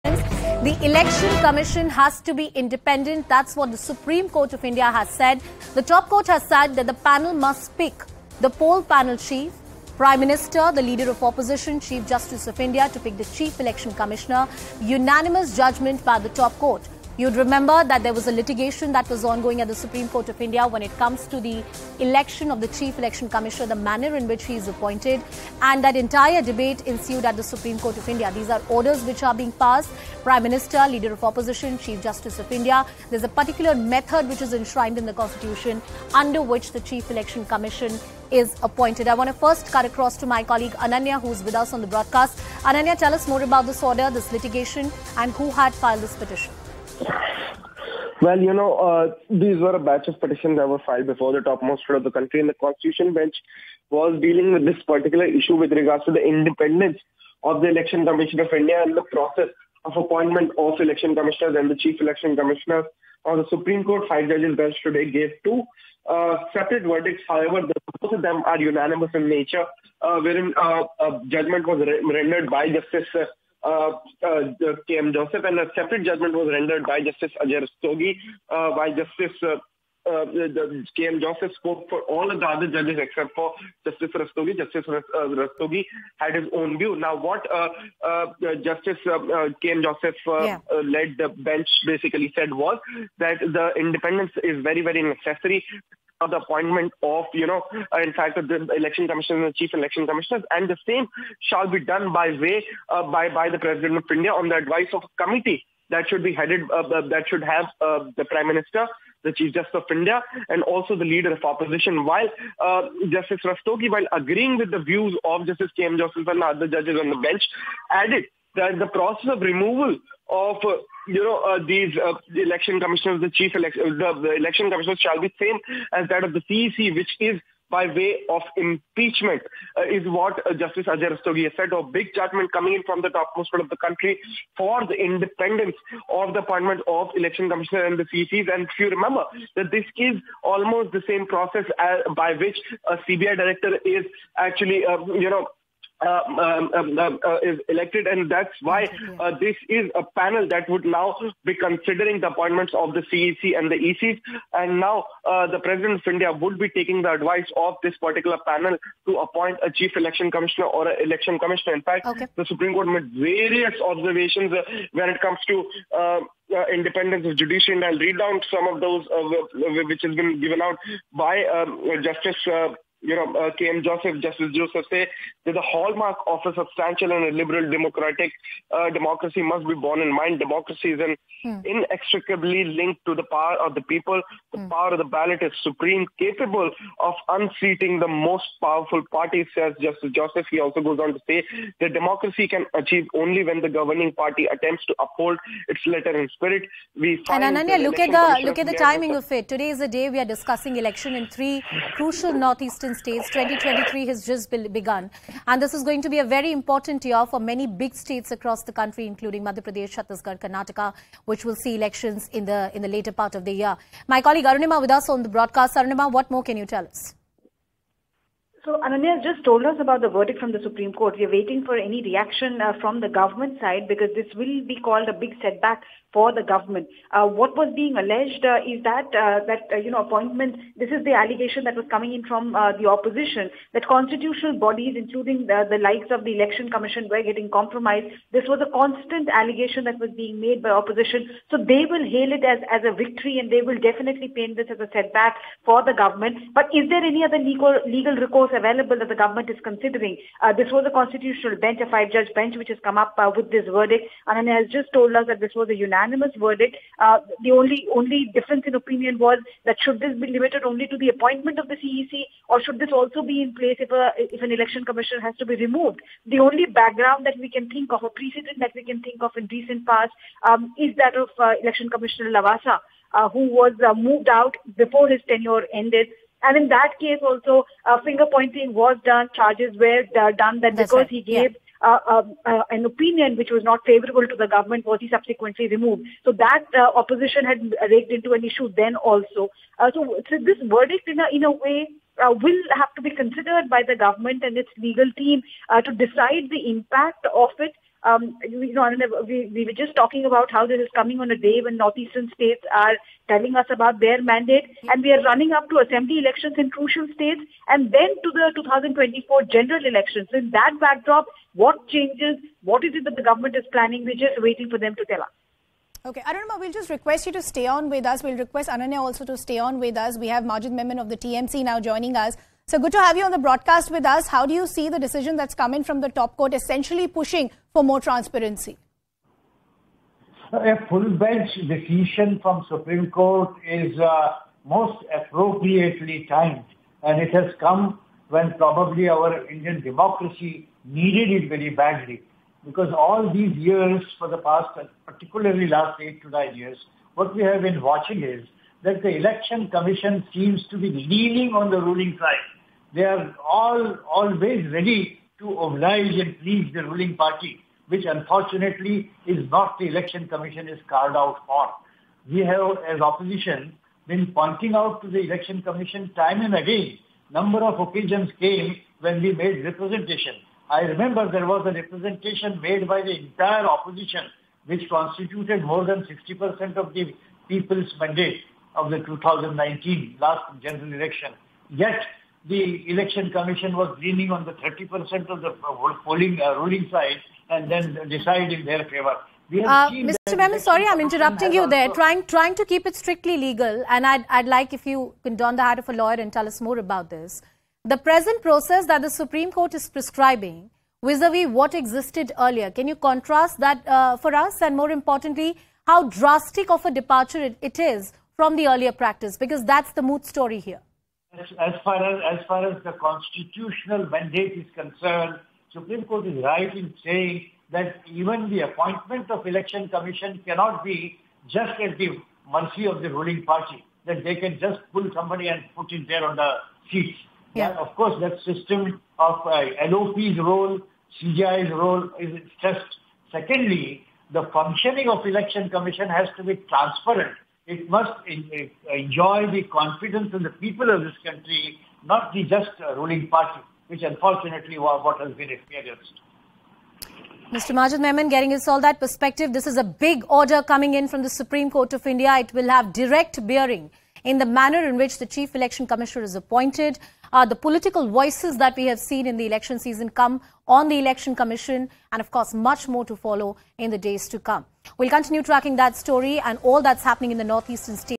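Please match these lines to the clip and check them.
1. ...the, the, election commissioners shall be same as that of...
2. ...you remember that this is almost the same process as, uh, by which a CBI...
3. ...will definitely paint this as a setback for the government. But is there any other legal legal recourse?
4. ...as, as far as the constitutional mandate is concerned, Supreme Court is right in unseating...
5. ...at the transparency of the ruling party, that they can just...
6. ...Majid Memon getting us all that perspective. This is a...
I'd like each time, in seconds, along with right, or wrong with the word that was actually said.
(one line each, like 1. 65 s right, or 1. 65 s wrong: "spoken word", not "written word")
1. 123 s right
2. 138 s right
3. 243 s right
4. 412 s wrong: "saying", not "unseating"
5. 421 s wrong: "mercy", not "transparency"
6. 447 s right.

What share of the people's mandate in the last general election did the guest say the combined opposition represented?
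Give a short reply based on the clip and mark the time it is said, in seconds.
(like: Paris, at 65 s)
More than 60%, at 375 s.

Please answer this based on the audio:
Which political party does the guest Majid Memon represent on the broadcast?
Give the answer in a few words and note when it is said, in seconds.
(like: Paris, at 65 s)
TMC, at 321 s.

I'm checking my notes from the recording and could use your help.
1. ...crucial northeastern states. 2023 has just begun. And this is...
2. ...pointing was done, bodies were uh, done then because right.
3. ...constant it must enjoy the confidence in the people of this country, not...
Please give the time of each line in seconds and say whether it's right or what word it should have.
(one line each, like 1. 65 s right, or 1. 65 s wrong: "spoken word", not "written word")
1. 201 s right
2. 278 s wrong: "charges", not "bodies"
3. 436 s wrong: "transparent", not "constant".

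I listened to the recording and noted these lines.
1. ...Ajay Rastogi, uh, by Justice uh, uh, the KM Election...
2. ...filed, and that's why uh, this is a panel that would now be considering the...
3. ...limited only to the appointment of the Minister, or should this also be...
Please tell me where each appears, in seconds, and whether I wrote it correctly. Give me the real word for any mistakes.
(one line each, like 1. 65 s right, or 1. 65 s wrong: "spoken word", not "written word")
1. 77 s wrong: "Joseph", not "Election"
2. 147 s wrong: "elected", not "filed"
3. 260 s wrong: "CEC", not "Minister".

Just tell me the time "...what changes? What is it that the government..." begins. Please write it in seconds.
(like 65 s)
311 s.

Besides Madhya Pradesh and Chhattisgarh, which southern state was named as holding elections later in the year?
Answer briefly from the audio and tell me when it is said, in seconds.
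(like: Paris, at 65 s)
Karnataka, at 210 s.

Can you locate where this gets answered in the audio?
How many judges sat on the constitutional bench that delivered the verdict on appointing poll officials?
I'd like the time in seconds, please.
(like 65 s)
251 s.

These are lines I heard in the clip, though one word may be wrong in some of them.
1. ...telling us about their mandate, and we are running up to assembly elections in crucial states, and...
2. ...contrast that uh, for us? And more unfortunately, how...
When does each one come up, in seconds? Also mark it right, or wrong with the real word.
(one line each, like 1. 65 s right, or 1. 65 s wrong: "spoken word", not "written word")
1. 303 s right
2. 402 s wrong: "importantly", not "unfortunately".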